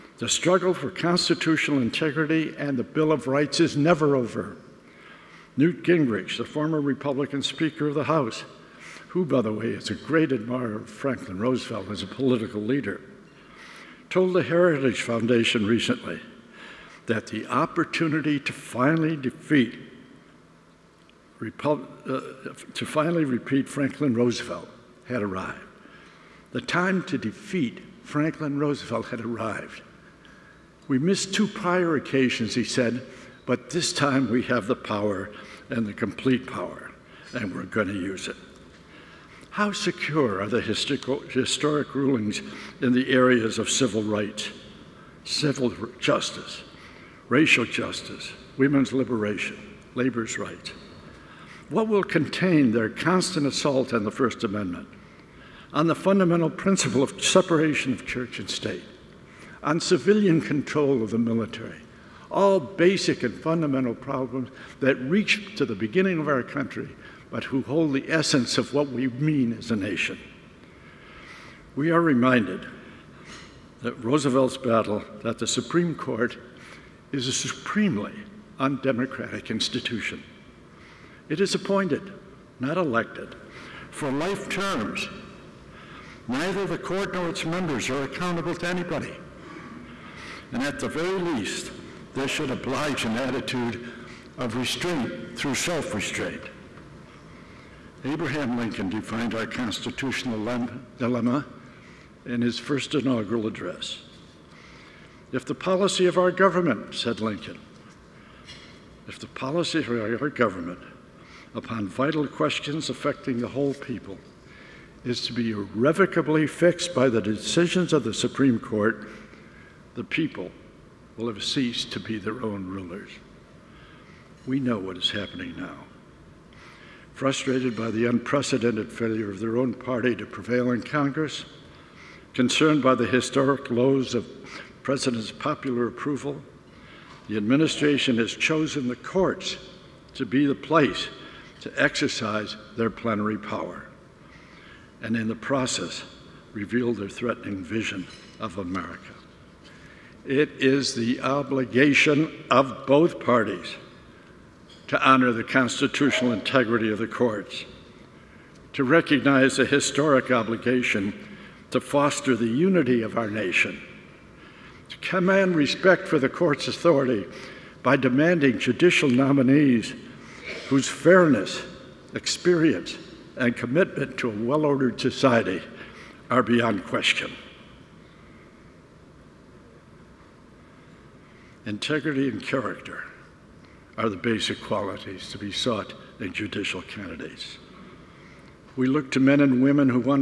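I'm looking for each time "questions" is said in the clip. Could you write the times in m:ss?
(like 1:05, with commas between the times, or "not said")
1:52, 2:56.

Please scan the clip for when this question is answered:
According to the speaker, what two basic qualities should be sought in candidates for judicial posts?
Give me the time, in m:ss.
3:01.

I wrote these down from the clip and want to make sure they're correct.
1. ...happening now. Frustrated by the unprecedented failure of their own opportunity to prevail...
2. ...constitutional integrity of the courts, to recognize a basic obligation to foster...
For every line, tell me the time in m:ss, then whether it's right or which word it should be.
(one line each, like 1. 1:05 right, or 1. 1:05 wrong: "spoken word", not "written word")
1. 2:05 wrong: "party", not "opportunity"
2. 2:35 wrong: "historic", not "basic".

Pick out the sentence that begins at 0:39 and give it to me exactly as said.
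How secure are the historic rulings in the areas of civil rights, civil justice, racial justice, women's liberation, labor's rights?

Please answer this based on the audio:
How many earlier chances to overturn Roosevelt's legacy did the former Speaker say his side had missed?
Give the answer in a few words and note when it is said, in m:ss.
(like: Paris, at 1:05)
2, at 0:31.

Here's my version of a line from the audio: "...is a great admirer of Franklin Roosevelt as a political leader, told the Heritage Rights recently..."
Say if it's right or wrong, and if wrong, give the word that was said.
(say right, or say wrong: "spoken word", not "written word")
wrong: "Foundation", not "Rights".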